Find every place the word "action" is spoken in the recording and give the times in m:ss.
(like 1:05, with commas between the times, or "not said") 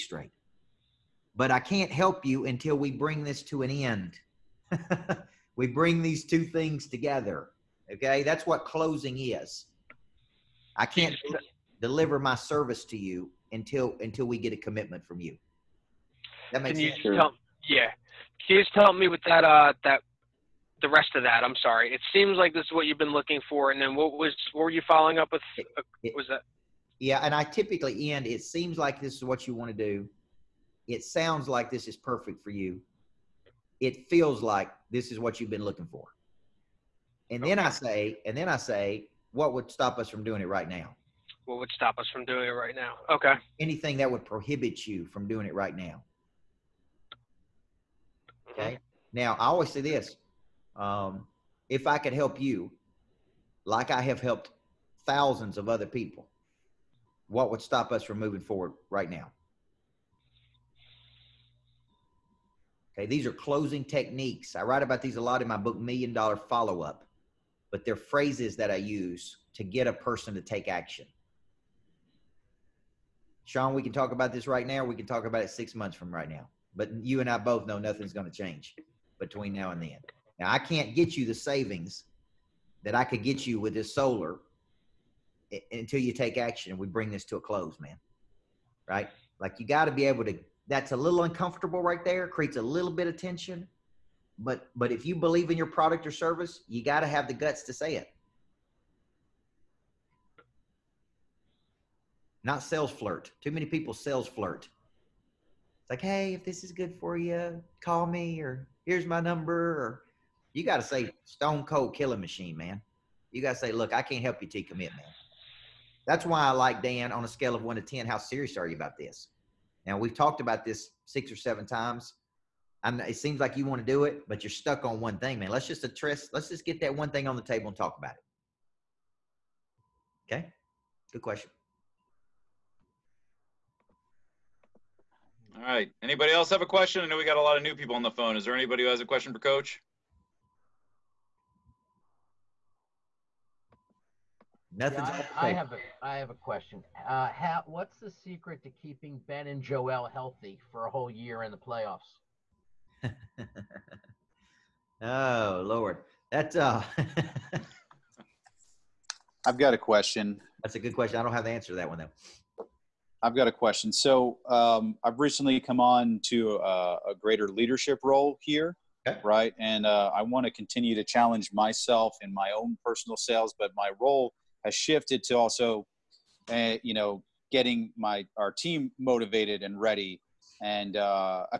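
1:10, 1:26.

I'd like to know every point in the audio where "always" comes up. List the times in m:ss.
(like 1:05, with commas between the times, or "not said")
0:49.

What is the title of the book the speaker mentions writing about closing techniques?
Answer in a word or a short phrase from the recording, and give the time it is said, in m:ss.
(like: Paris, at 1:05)
Million Dollar Follow Up, at 1:05.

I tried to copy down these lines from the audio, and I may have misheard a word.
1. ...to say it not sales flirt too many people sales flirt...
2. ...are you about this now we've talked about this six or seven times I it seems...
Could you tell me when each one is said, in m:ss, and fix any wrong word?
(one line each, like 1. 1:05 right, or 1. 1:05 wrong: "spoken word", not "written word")
1. 1:37 right
2. 1:58 right.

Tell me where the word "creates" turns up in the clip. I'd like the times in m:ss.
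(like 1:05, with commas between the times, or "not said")
1:32.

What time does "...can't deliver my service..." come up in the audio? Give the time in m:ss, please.
0:10.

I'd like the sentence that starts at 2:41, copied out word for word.
I don't have the answer to that one though.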